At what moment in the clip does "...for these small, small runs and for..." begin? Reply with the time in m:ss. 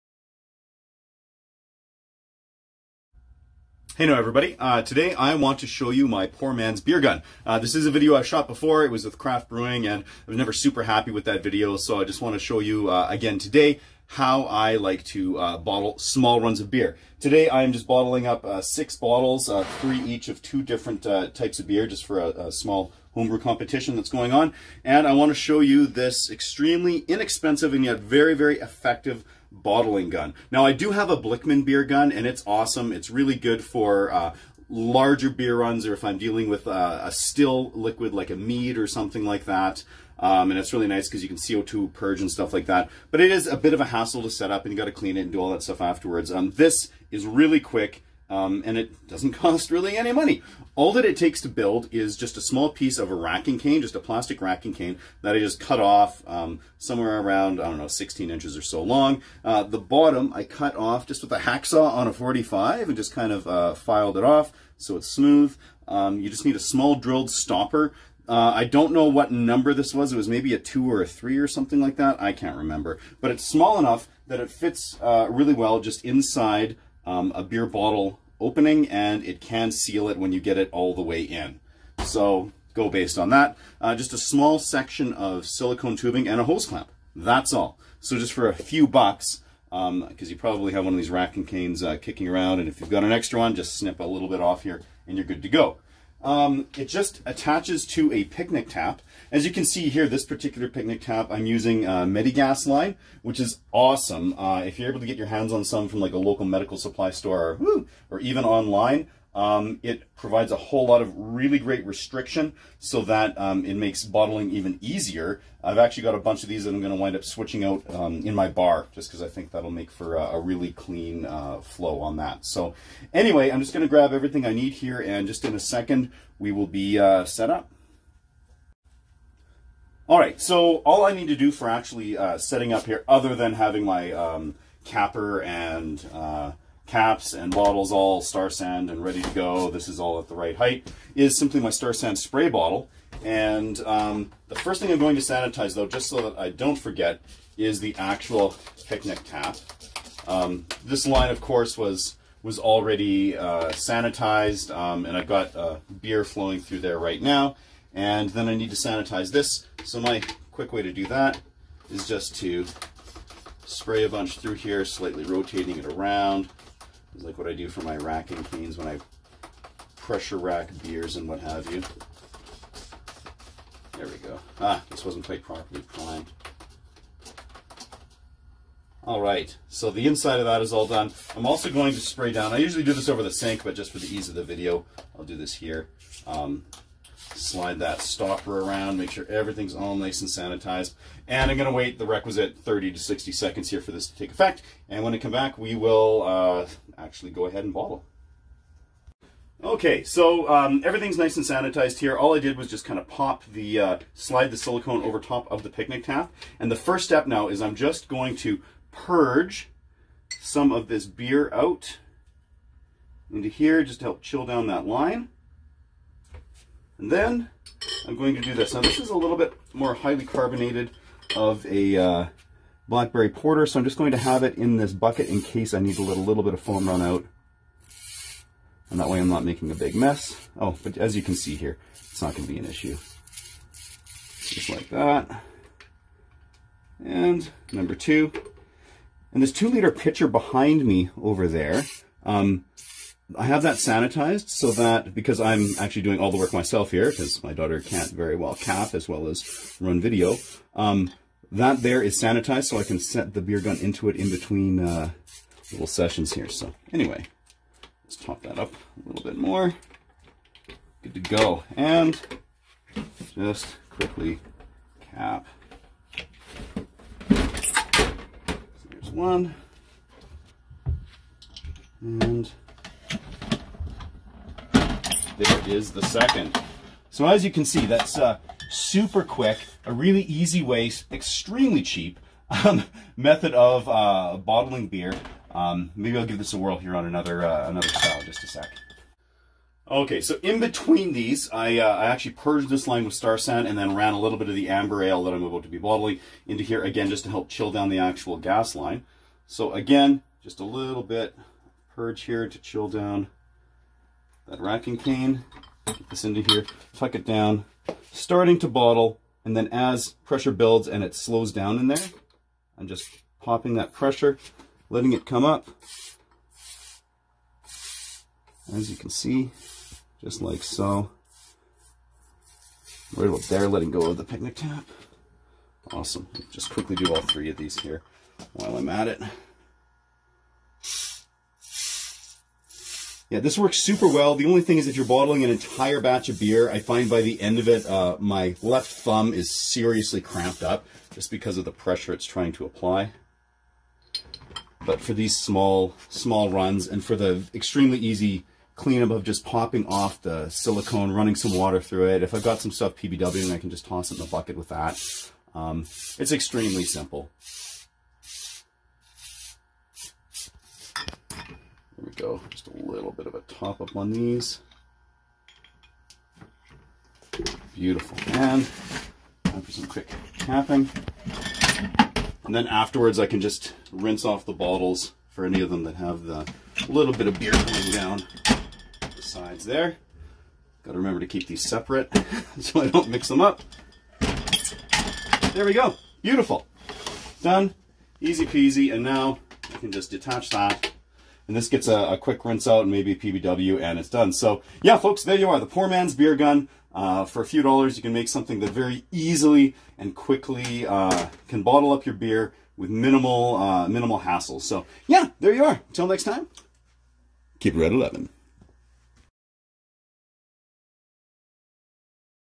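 5:44.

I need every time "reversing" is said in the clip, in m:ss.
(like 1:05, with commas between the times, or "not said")
not said.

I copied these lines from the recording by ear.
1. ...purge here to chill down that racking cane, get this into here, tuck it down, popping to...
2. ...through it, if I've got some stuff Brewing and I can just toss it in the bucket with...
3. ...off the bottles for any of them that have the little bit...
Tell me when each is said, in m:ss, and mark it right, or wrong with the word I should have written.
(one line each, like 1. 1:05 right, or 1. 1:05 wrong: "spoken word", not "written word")
1. 5:01 wrong: "starting", not "popping"
2. 5:51 wrong: "PBW", not "Brewing"
3. 6:14 right.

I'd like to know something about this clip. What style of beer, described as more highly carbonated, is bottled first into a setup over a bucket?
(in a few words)
Blackberry porter.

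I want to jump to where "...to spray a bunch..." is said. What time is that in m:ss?
2:42.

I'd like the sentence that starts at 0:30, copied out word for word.
Now I do have a Blichmann beer gun and it's awesome.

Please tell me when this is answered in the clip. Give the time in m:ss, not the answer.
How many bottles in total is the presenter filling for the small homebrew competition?
0:18.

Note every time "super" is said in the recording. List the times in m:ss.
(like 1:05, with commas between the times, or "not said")
0:10, 4:38, 5:33.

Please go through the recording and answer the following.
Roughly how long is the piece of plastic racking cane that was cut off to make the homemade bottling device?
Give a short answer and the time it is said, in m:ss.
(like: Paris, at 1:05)
16 inches, at 0:57.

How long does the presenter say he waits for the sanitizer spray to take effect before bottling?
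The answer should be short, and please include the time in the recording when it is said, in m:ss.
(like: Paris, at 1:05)
30 to 60 seconds, at 3:12.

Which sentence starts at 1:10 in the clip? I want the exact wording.
It was maybe a two or a three or something like that.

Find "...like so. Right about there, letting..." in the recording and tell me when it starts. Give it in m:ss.
5:20.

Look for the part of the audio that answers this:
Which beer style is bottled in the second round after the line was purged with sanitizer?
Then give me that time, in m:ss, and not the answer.
4:54.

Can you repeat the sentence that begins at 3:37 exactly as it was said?
And then I'm going to do this.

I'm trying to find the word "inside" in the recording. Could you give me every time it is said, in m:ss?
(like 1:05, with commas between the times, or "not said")
1:16, 3:00.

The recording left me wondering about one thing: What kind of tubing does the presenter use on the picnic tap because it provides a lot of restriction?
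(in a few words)
Medigas line.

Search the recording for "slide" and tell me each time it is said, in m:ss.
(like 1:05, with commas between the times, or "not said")
3:07, 3:24.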